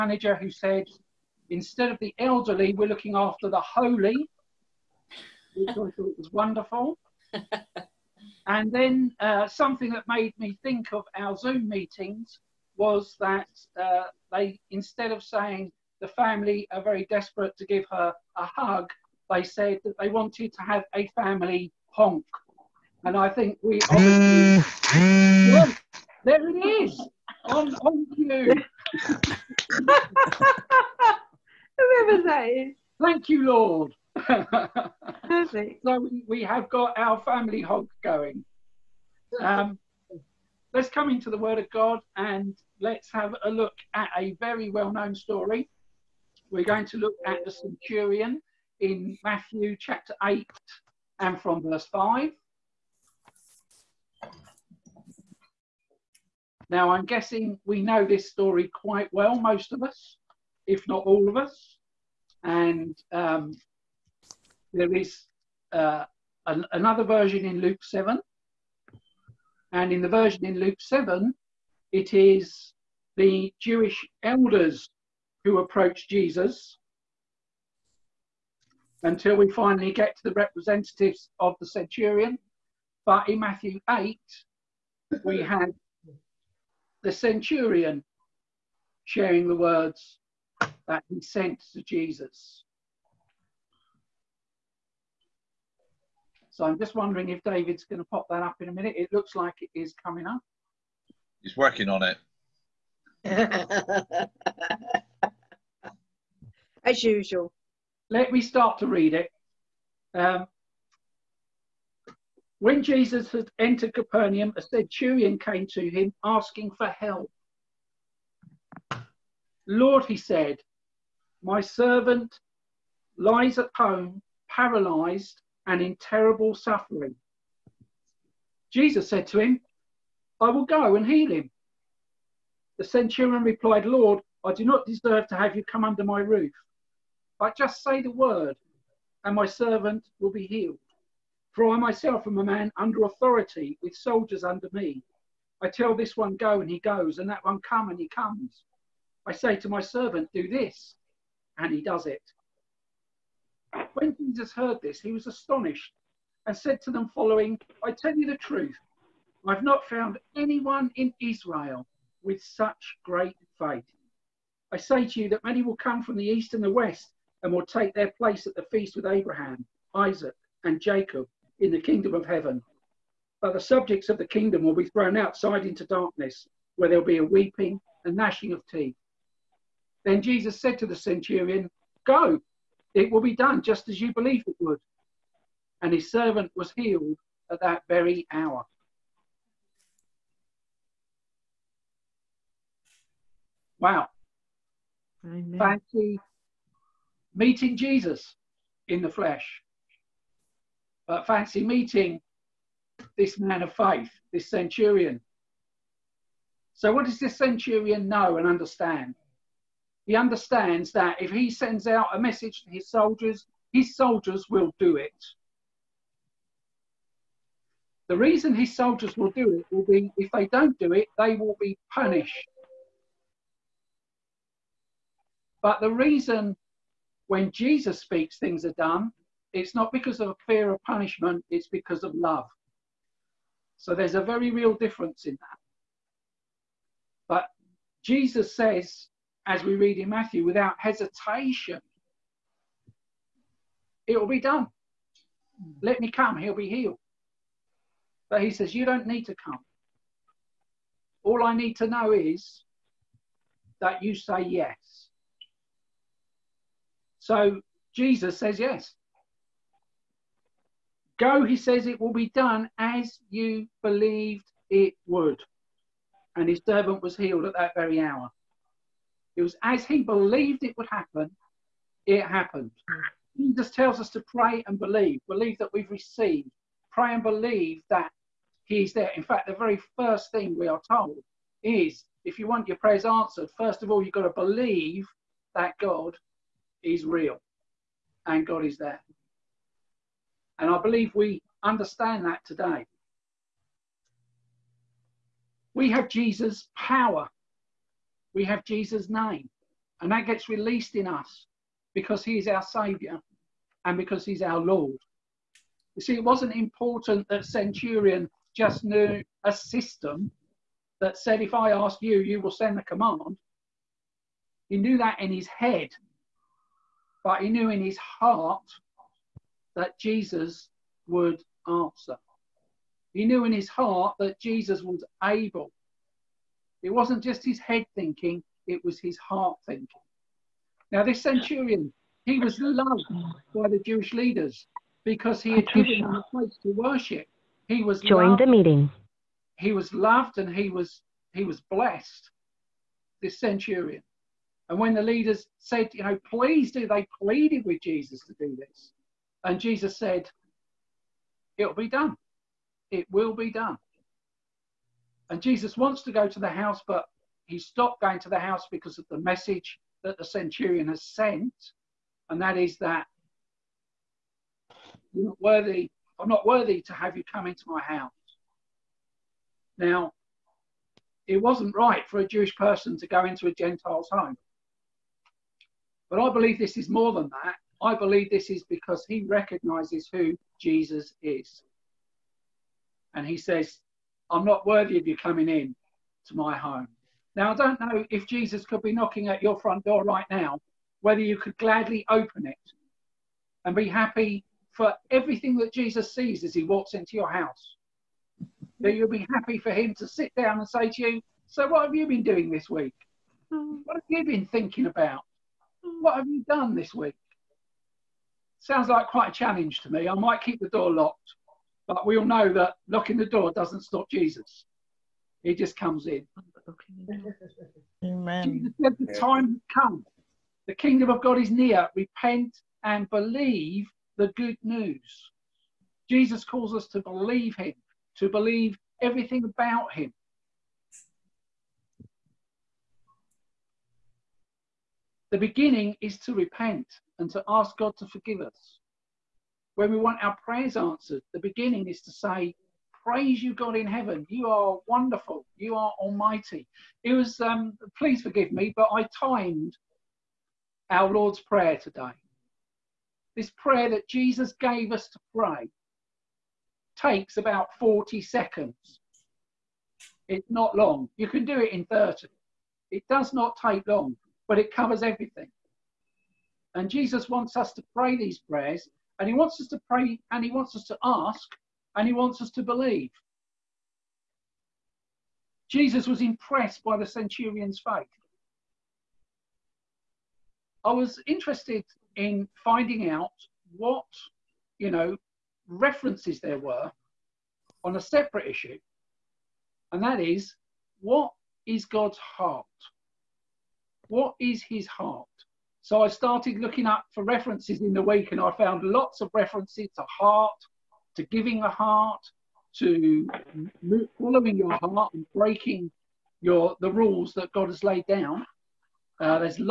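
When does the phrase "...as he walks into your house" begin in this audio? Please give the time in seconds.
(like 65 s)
396 s.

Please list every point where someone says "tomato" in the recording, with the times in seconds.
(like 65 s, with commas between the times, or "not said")
not said.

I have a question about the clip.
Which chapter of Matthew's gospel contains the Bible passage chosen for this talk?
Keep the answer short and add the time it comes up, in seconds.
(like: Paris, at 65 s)
Chapter 8, at 49 s.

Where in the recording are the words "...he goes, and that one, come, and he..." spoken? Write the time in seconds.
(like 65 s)
146 s.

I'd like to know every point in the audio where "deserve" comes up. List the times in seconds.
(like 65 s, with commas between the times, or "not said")
134 s.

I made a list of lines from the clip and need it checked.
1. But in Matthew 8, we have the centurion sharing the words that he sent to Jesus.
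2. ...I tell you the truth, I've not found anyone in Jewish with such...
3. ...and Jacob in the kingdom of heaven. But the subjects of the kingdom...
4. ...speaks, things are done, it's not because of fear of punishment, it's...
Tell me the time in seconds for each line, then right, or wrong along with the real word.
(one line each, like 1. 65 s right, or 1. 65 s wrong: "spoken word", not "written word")
1. 83 s right
2. 157 s wrong: "Israel", not "Jewish"
3. 170 s right
4. 227 s right.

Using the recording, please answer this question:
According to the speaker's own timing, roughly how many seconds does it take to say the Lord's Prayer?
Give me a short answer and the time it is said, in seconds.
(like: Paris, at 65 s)
40 seconds, at 457 s.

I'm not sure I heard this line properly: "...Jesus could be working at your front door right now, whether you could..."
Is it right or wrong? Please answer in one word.
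wrong.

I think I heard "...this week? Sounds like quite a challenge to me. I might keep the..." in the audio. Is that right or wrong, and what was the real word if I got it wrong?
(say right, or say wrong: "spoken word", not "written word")
right.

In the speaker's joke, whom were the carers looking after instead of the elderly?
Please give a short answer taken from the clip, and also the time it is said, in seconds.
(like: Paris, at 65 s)
The holy, at 3 s.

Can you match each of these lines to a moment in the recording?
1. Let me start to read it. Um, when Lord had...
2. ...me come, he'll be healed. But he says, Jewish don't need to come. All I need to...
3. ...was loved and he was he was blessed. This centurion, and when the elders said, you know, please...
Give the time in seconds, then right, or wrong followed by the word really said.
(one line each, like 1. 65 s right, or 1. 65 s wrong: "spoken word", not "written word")
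1. 108 s wrong: "Jesus", not "Lord"
2. 245 s wrong: "You", not "Jewish"
3. 339 s wrong: "leaders", not "elders".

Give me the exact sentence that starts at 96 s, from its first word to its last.
So I'm just wondering if David's going to pop that up in a minute.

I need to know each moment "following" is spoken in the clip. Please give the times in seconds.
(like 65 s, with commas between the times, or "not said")
157 s, 504 s.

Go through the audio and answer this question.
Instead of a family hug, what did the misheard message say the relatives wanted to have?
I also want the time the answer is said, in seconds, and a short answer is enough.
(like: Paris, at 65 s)
A family honk, at 21 s.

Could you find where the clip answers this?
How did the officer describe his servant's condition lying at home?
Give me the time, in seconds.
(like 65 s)
124 s.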